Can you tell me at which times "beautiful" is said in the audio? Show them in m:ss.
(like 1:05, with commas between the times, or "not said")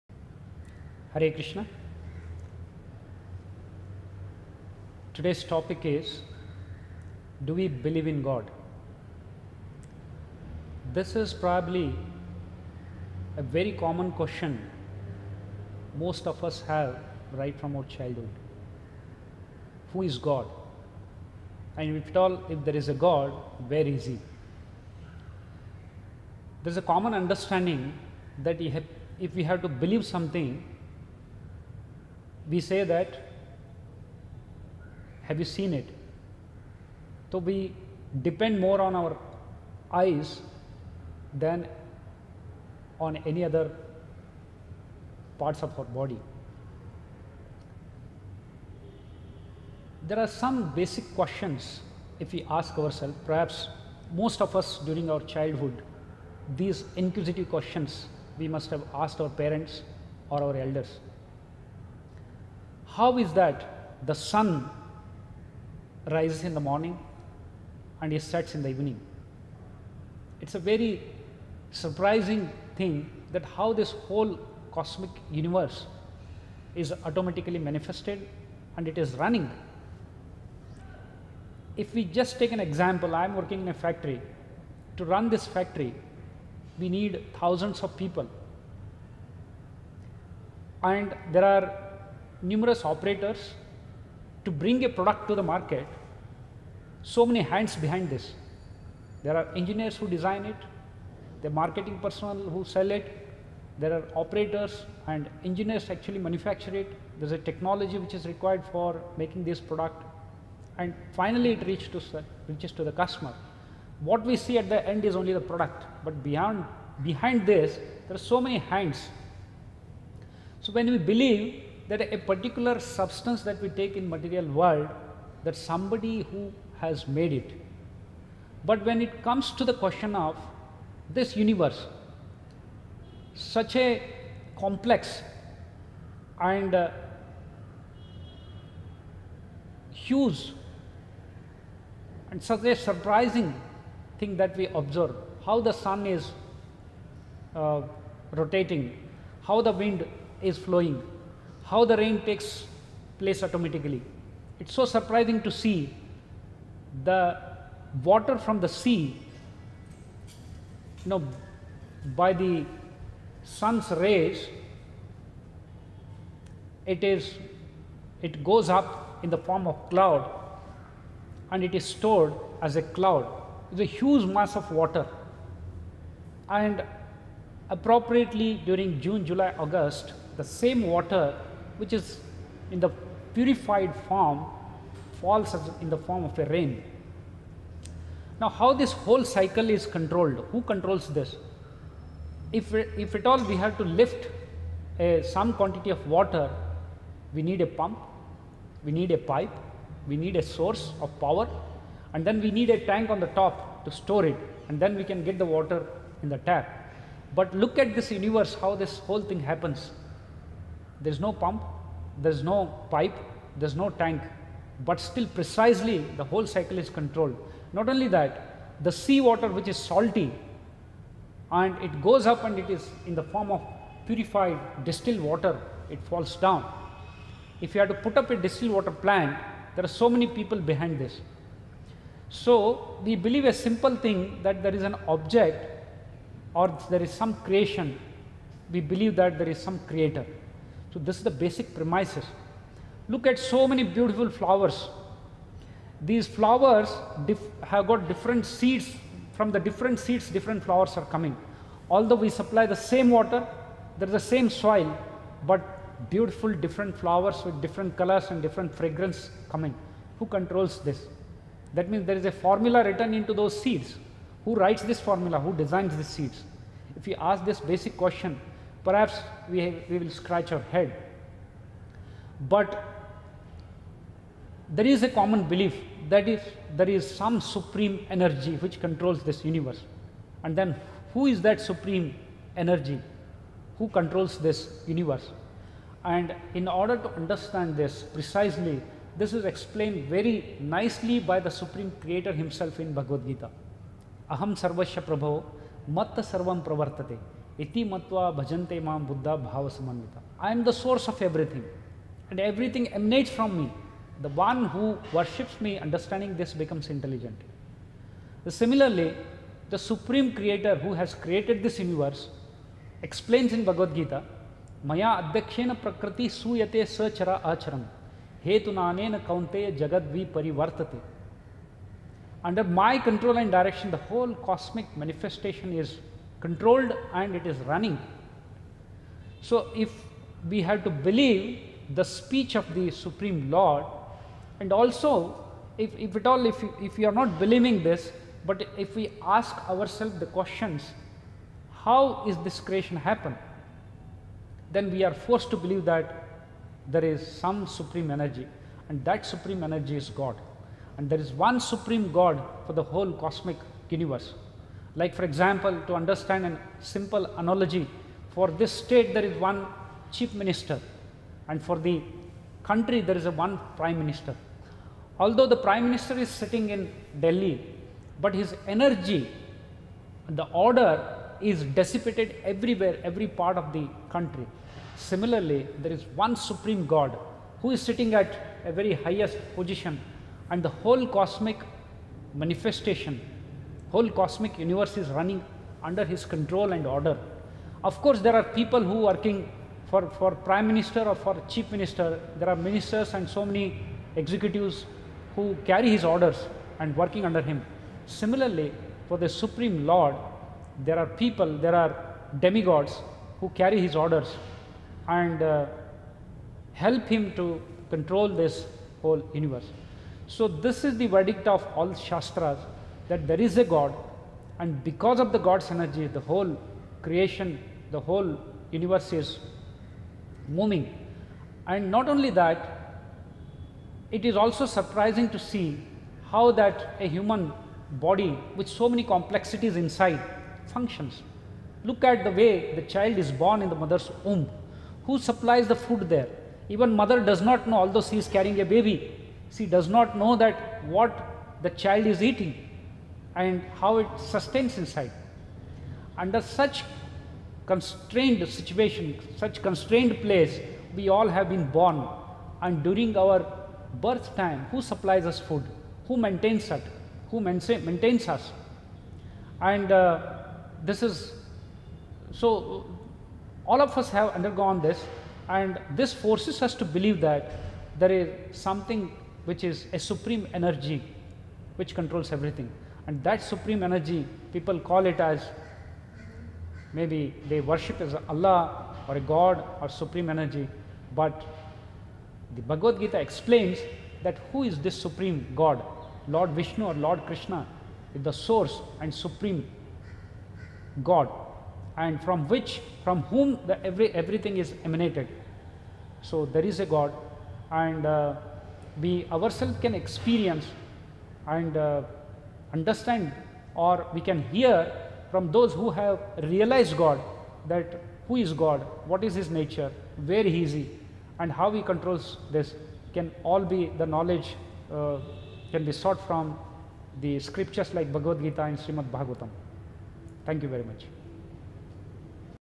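4:03, 4:16.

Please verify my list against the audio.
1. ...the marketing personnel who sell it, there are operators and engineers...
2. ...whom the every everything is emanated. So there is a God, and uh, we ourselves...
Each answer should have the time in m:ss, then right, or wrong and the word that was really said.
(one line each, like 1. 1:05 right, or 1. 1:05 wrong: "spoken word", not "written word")
1. 1:41 right
2. 8:13 right.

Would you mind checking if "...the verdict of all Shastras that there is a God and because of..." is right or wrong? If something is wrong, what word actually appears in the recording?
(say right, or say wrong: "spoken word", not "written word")
right.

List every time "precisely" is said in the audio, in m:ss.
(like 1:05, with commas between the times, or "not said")
3:35, 4:48.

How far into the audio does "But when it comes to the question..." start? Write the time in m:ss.
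2:08.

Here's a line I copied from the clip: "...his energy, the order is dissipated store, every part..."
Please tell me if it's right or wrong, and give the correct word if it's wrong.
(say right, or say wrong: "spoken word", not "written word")
wrong: "everywhere", not "store".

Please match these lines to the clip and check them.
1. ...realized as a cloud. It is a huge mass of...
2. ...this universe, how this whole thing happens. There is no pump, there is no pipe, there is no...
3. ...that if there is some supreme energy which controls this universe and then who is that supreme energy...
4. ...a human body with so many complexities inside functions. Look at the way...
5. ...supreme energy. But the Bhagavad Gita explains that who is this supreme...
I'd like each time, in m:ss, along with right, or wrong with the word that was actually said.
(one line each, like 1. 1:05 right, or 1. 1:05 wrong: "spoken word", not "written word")
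1. 2:51 wrong: "stored", not "realized"
2. 3:27 right
3. 4:36 right
4. 7:07 right
5. 7:59 right.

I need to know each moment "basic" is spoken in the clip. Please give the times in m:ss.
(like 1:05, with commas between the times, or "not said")
0:50, 4:01, 4:27.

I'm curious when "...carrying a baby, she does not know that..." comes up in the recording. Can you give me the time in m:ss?
7:18.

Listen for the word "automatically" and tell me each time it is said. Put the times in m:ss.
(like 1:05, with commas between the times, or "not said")
1:17, 2:33.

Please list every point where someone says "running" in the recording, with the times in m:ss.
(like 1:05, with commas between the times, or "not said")
1:19, 5:27, 6:25.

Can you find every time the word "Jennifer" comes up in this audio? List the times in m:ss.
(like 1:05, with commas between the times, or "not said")
not said.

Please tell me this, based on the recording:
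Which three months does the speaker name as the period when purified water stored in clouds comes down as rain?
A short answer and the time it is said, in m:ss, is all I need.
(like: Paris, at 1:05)
June, July, August, at 2:58.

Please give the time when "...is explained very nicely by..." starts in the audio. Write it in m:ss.
4:49.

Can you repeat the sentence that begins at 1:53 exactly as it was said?
What we see at the end is only the product, but beyond, behind this there are so many hands.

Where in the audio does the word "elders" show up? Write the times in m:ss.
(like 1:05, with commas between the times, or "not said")
1:00.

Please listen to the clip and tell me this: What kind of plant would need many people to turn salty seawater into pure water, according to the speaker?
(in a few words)
Distilled water plant.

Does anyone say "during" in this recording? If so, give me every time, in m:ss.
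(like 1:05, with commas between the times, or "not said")
0:54, 2:58, 7:32.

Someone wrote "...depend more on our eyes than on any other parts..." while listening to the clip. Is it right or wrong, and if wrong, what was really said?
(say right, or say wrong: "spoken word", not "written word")
right.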